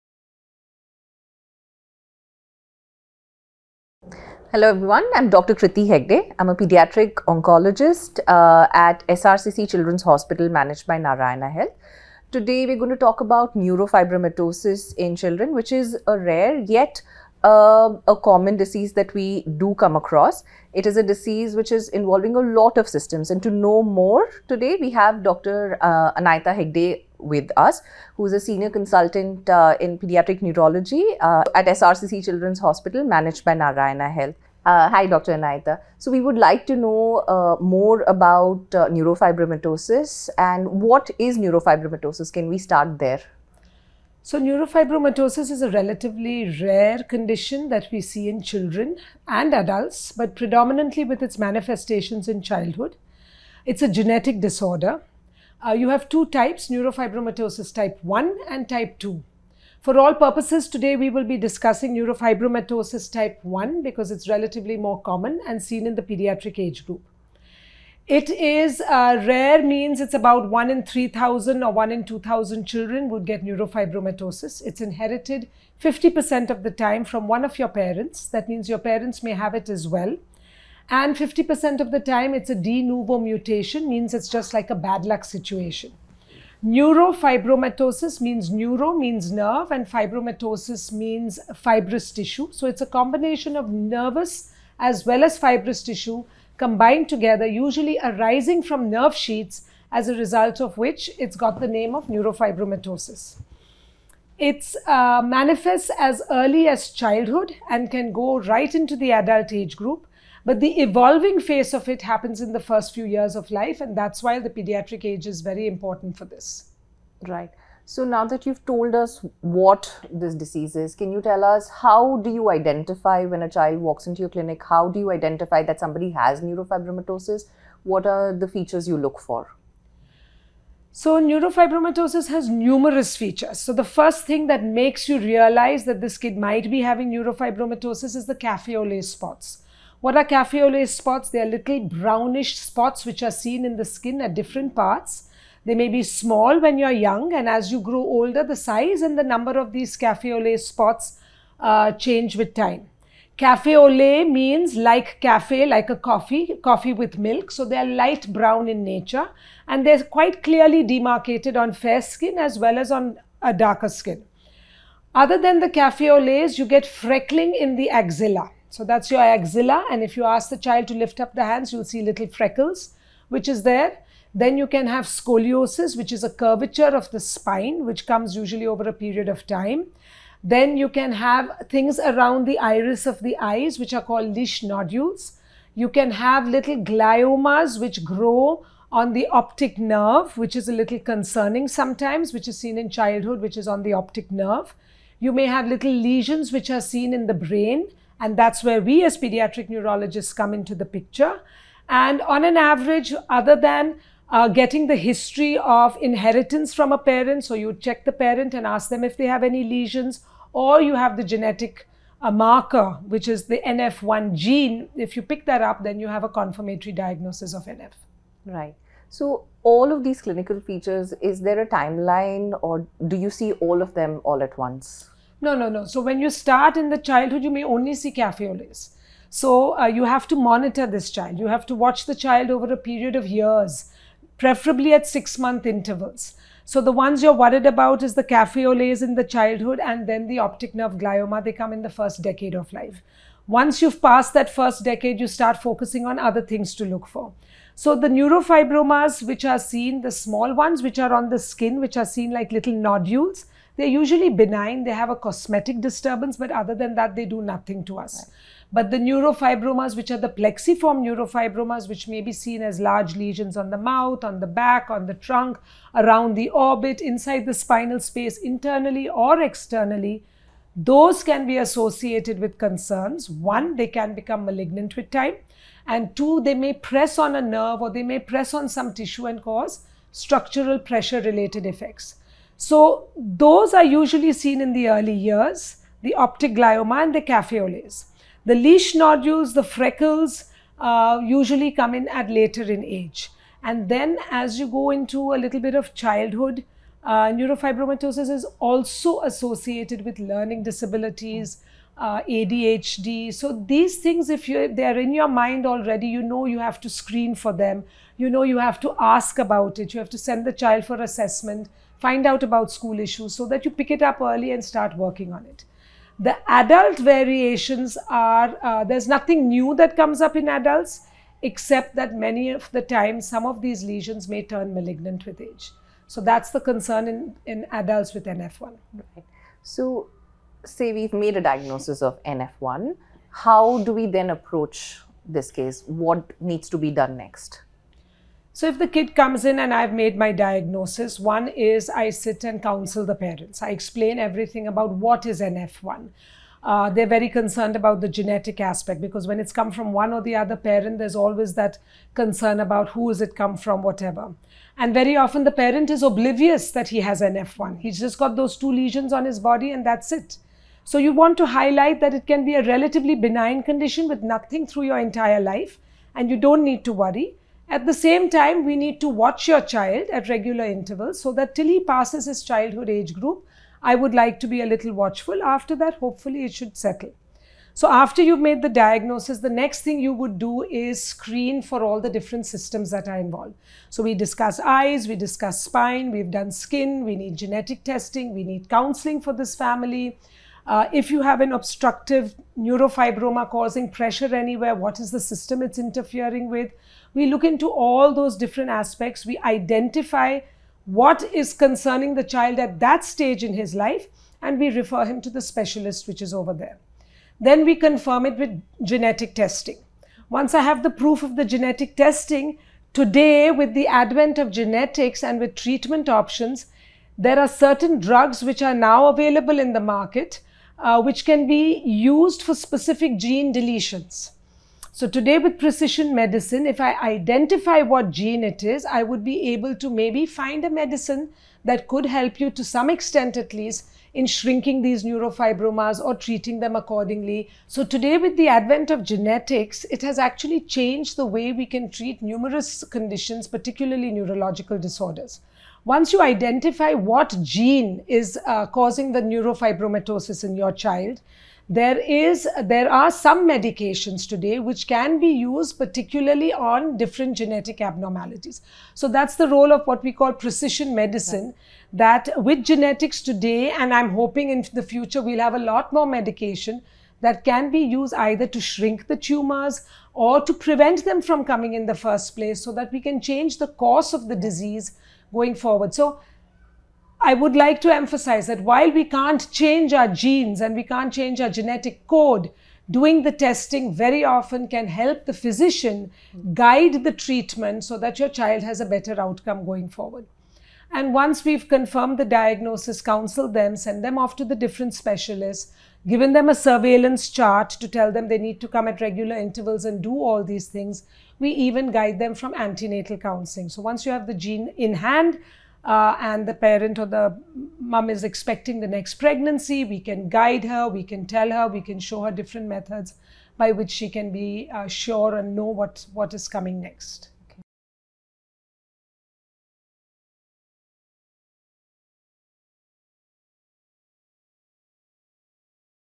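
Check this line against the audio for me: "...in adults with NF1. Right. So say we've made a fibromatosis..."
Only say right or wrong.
wrong.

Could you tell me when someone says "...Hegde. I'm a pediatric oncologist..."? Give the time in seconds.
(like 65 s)
5 s.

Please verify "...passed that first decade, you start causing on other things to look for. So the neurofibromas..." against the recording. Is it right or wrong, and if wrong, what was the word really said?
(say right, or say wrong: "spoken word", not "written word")
wrong: "focusing", not "causing".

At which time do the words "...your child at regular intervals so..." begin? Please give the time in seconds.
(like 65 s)
369 s.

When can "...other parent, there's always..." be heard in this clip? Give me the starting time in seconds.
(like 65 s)
350 s.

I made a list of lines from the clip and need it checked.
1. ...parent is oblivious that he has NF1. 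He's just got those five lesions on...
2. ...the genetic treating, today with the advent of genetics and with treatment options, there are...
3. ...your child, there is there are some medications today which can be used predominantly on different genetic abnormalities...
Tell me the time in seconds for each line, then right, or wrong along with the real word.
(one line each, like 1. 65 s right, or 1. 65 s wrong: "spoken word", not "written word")
1. 355 s wrong: "two", not "five"
2. 411 s wrong: "testing", not "treating"
3. 450 s wrong: "particularly", not "predominantly".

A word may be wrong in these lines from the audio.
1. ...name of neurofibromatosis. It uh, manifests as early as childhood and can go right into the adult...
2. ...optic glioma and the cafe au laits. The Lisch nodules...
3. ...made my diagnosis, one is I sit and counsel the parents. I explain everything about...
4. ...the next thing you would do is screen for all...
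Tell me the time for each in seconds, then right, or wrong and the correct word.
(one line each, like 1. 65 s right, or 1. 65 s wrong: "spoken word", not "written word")
1. 101 s right
2. 286 s right
3. 339 s right
4. 379 s right.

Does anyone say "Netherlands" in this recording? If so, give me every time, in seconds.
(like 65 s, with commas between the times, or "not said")
not said.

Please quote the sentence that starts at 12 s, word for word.
Today we're going to talk about neurofibromatosis in children, which is a rare yet a common disease that we do come across.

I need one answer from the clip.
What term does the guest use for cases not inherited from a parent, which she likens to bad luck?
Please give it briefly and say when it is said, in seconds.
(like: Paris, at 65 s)
De novo mutation, at 82 s.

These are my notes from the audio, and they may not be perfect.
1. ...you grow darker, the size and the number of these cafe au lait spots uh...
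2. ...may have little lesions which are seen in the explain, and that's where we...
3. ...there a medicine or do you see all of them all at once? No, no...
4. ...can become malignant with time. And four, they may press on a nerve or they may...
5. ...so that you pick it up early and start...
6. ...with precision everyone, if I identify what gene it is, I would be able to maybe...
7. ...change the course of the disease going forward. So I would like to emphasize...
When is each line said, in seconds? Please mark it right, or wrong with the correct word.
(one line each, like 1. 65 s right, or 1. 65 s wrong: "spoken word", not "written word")
1. 147 s wrong: "older", not "darker"
2. 195 s wrong: "brain", not "explain"
3. 221 s wrong: "timeline", not "medicine"
4. 273 s wrong: "two", not "four"
5. 313 s right
6. 425 s wrong: "medicine", not "everyone"
7. 473 s right.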